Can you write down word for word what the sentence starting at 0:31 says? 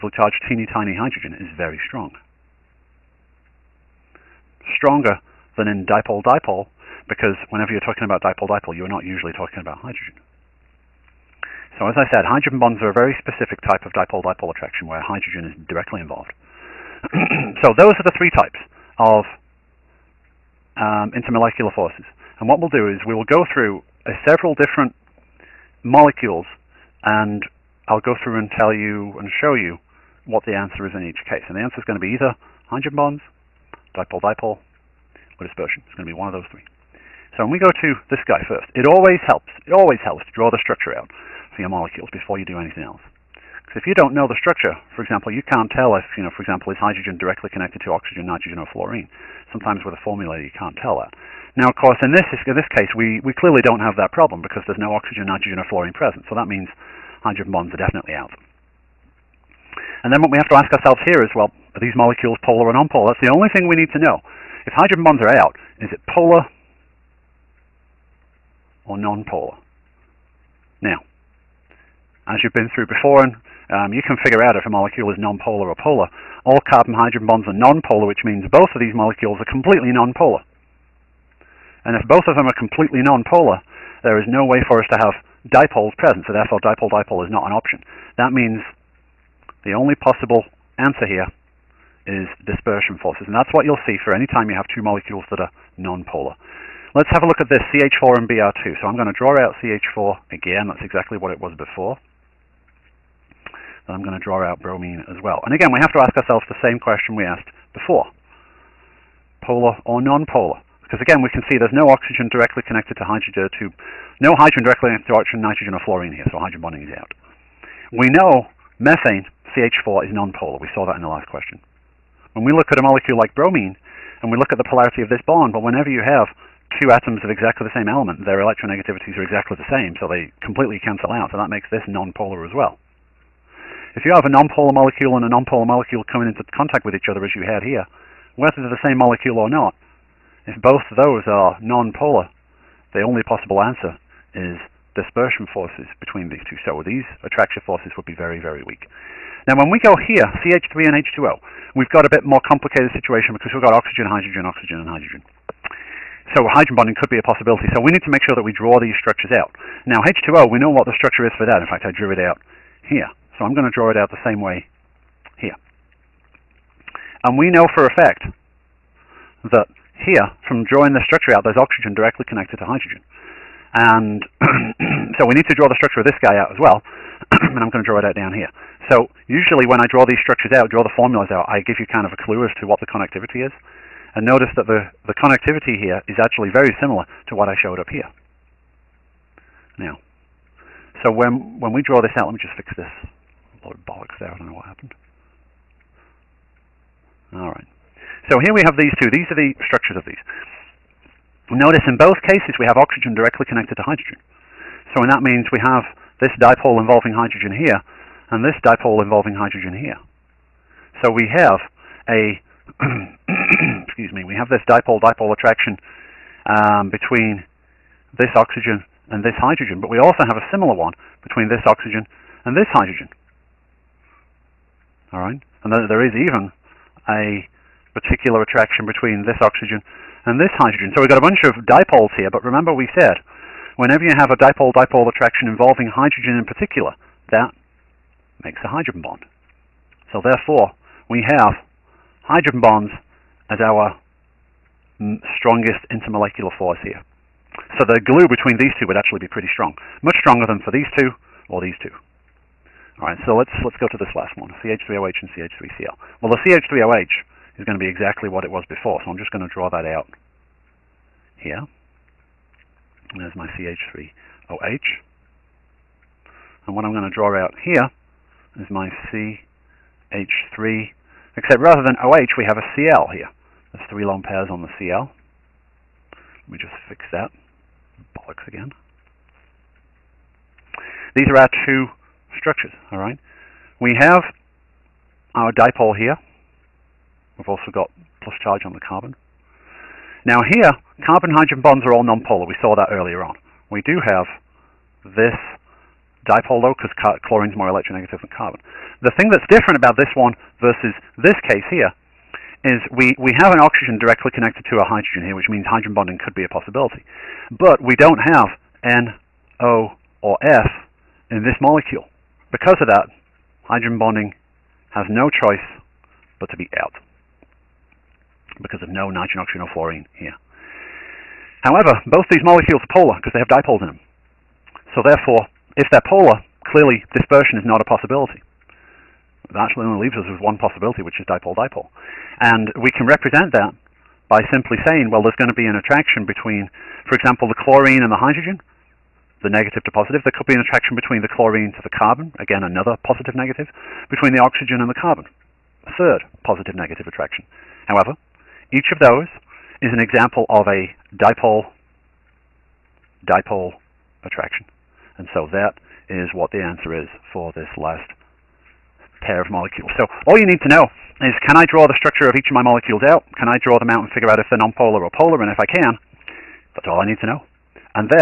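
And the answer is going to be either hydrogen bonds, dipole-dipole, or dispersion.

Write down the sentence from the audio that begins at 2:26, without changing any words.
So these attraction forces would be very, very weak.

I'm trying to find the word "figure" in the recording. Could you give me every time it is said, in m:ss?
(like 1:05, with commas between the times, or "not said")
1:14, 6:04.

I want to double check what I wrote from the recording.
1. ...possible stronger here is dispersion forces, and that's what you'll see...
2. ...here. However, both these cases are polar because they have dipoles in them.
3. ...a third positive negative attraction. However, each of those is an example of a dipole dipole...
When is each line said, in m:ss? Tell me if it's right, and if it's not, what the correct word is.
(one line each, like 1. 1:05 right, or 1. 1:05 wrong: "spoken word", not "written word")
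1. 1:30 wrong: "answer", not "stronger"
2. 5:20 wrong: "molecules", not "cases"
3. 5:45 right.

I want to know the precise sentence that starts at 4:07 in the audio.
So the glue between these two would actually be pretty strong.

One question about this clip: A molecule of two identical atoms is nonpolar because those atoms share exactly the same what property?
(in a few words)
Electronegativities.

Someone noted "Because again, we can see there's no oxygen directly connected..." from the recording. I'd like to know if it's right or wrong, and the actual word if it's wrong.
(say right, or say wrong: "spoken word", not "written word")
right.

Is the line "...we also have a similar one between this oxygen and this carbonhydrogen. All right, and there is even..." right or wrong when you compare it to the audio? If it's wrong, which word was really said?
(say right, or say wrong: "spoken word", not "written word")
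wrong: "hydrogen", not "carbonhydrogen".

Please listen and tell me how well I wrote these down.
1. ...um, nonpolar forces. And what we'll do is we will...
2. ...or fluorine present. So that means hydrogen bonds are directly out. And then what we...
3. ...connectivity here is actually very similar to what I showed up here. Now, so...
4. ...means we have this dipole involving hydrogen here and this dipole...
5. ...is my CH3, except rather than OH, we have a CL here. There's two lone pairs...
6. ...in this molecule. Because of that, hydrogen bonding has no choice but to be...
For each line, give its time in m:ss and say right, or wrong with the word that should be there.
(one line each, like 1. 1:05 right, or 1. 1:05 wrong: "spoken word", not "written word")
1. 0:20 wrong: "intermolecular", not "nonpolar"
2. 0:55 wrong: "definitely", not "directly"
3. 3:05 right
4. 3:25 right
5. 4:28 wrong: "three", not "two"
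6. 5:11 right.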